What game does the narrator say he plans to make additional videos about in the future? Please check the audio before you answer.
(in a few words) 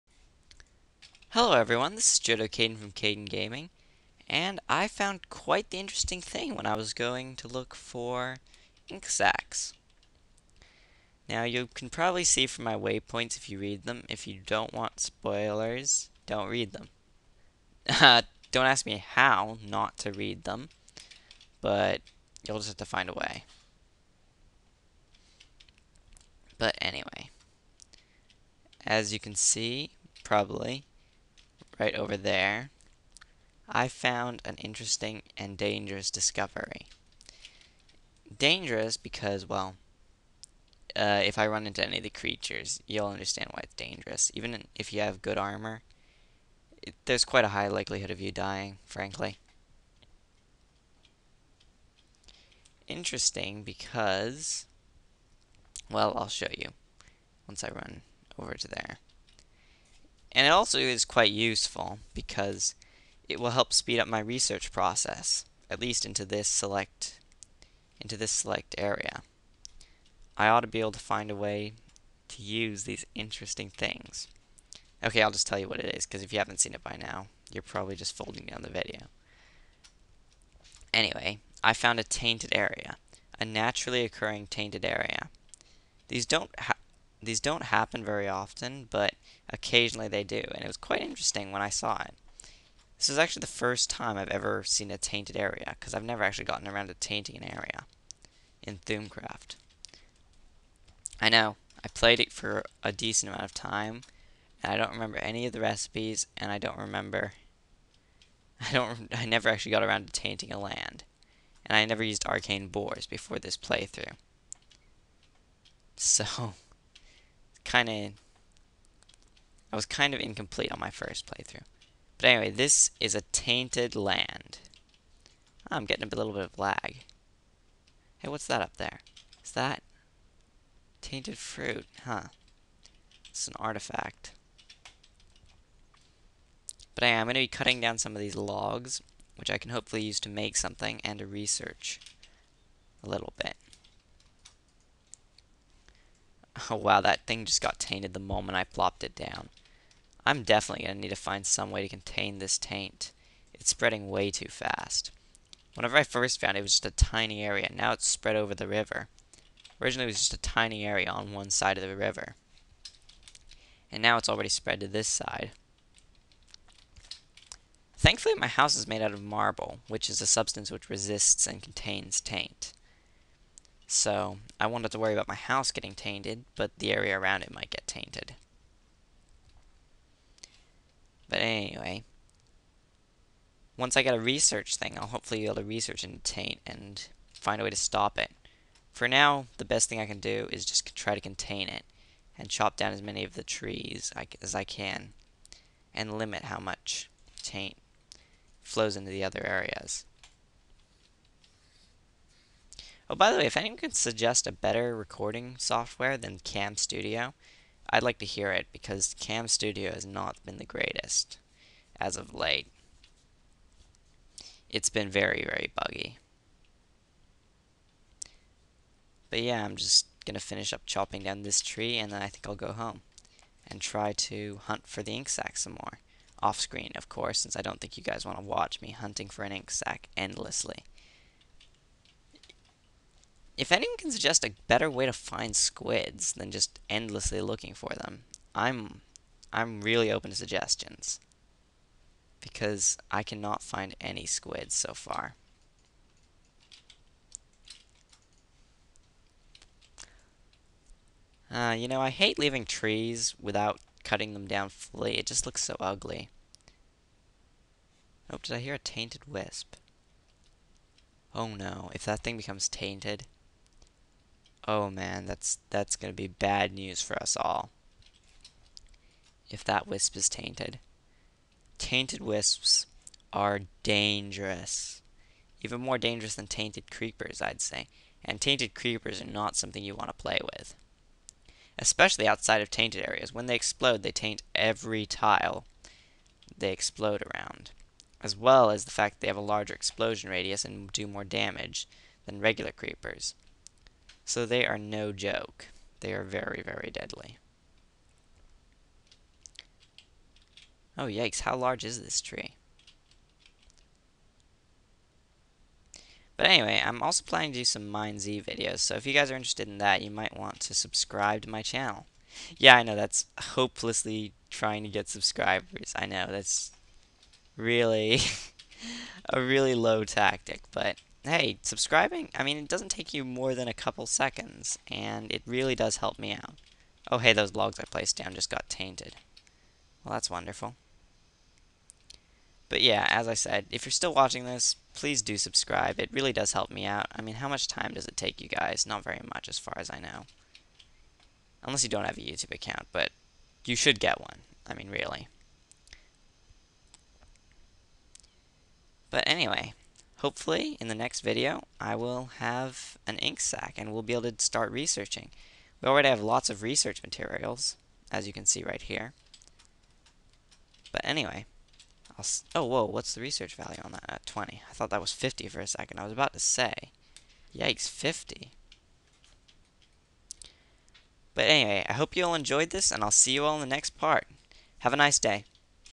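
Mine Z.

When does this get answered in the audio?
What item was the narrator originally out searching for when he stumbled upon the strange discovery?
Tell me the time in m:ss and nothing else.
0:08.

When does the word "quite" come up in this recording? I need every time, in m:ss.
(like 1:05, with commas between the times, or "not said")
0:05, 0:47, 1:01, 1:30.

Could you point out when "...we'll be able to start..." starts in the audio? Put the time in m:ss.
5:53.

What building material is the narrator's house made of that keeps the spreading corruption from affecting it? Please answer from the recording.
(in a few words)
Marble.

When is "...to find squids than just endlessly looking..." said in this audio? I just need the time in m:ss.
3:55.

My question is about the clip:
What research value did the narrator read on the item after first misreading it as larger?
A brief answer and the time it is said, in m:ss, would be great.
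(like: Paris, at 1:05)
20, at 6:04.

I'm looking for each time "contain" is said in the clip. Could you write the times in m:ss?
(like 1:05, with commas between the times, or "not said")
2:31, 2:51, 3:11.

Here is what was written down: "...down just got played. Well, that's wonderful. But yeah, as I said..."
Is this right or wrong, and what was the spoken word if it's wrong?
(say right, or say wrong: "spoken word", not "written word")
wrong: "tainted", not "played".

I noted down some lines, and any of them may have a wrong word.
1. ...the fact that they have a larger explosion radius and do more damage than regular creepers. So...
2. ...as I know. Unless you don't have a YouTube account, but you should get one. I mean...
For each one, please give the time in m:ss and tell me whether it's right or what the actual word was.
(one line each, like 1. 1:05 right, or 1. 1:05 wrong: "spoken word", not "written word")
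1. 4:48 right
2. 5:39 right.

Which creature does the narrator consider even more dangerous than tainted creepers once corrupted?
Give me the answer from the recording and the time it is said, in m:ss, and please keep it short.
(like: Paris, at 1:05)
Tainted wisps, at 4:31.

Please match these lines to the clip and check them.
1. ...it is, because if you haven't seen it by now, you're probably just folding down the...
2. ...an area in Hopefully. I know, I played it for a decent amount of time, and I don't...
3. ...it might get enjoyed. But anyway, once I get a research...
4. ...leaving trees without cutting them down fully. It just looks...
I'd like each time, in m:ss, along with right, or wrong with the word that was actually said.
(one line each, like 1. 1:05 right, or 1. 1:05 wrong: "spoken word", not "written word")
1. 1:15 right
2. 1:37 wrong: "Thaumcraft", not "Hopefully"
3. 2:57 wrong: "tainted", not "enjoyed"
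4. 4:12 right.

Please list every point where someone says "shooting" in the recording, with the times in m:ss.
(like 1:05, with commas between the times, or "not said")
not said.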